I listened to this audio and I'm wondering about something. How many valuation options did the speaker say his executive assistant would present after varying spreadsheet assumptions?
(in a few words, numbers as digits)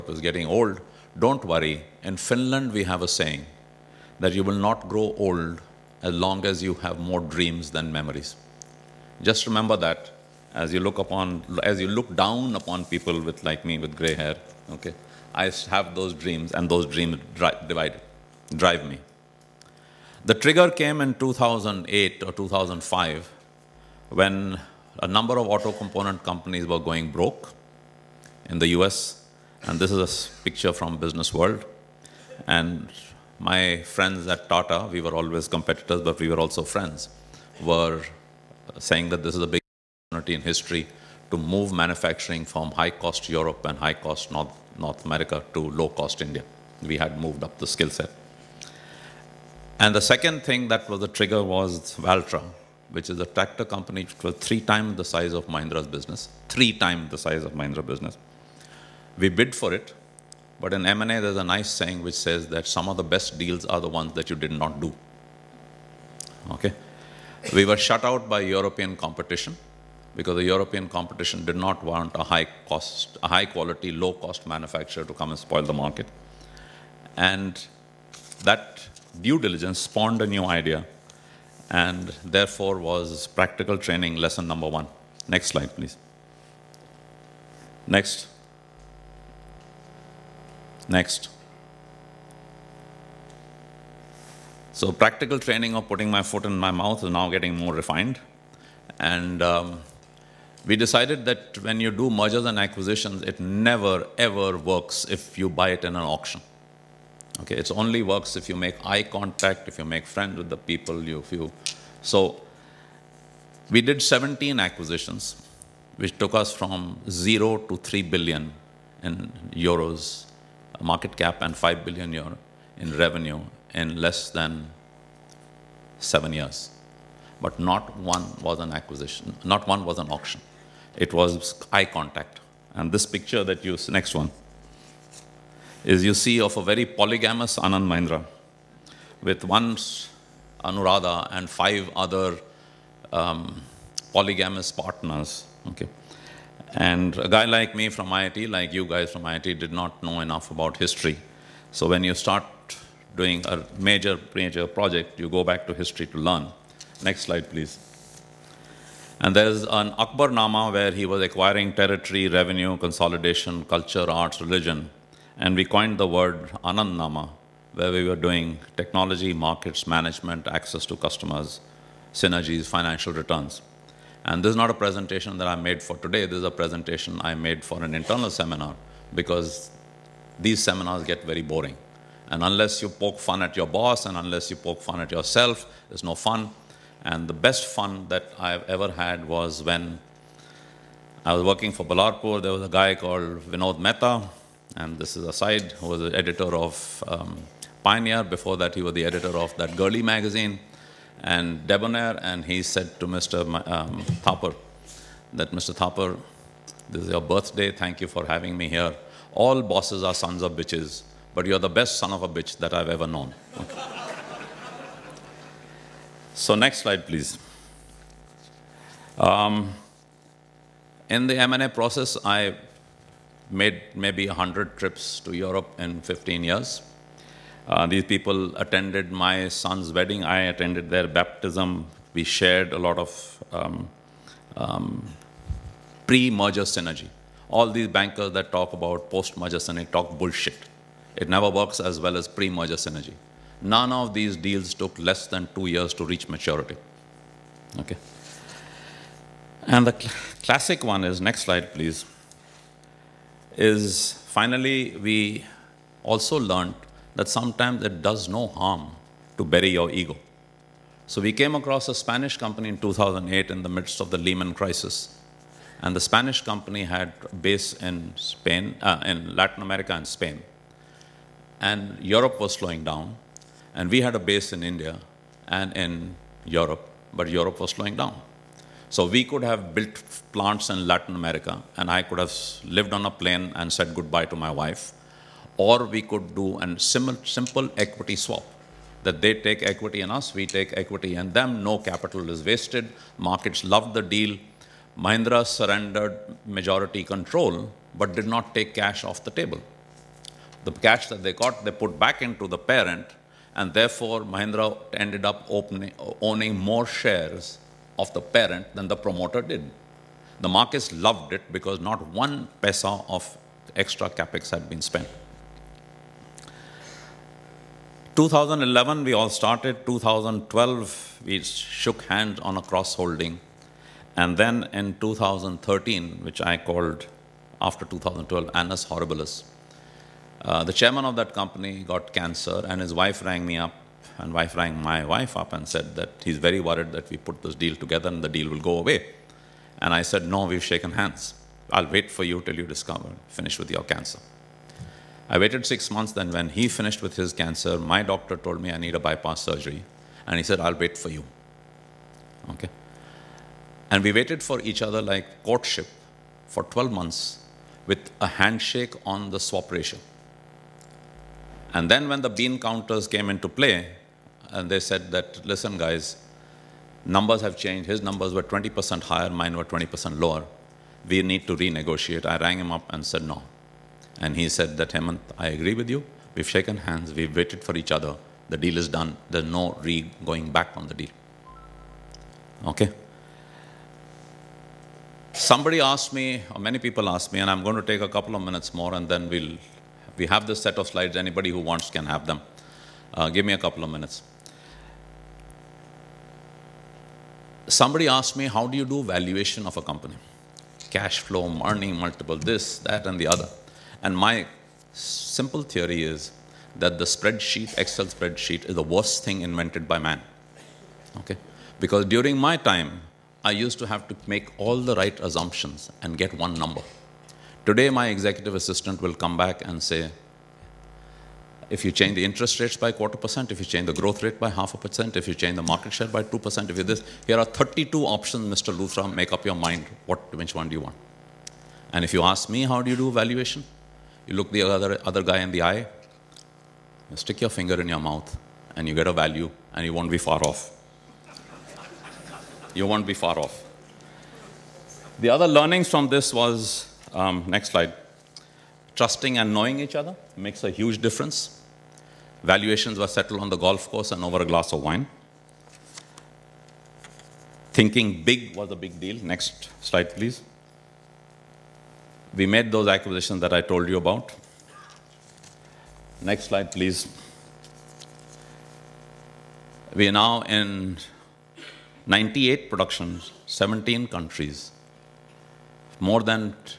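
32.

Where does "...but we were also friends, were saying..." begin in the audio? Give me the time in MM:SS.
00:36.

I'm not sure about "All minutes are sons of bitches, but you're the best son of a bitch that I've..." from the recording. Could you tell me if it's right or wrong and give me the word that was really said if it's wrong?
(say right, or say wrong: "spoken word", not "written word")
wrong: "bosses", not "minutes".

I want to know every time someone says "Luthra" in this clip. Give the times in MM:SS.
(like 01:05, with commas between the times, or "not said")
07:08.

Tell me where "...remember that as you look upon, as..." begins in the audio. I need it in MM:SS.
00:09.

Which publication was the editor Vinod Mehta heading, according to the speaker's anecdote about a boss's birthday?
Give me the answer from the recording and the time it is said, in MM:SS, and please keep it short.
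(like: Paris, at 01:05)
Pioneer, at 03:17.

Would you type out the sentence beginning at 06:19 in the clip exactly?
There's no re going back on the deal.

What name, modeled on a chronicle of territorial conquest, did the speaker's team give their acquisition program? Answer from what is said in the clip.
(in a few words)
Anand Nama.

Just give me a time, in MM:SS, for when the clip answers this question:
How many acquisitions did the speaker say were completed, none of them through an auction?
01:54.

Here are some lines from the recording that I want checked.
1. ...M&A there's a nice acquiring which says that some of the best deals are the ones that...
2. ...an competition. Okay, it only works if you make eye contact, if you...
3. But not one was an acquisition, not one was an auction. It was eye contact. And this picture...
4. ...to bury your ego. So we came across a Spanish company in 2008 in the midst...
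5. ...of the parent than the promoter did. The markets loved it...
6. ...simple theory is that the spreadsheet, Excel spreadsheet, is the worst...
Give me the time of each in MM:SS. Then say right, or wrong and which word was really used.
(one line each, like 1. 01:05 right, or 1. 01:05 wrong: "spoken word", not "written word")
1. 01:00 wrong: "saying", not "acquiring"
2. 01:45 wrong: "auction", not "competition"
3. 02:07 right
4. 04:19 right
5. 05:07 right
6. 06:44 right.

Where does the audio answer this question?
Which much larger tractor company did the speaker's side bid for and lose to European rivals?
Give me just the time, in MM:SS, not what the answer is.
00:51.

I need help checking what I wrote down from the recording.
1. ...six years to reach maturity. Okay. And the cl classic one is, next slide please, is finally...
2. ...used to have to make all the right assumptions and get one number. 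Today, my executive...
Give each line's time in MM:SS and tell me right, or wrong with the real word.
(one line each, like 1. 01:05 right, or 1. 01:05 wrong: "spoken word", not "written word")
1. 04:05 wrong: "two", not "six"
2. 06:53 right.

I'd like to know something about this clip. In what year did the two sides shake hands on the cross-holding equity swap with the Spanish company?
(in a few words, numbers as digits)
2012.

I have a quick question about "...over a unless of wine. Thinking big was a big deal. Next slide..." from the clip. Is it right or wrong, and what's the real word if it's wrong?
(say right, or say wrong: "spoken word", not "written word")
wrong: "glass", not "unless".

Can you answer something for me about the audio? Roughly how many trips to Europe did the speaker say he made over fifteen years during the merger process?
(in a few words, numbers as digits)
100.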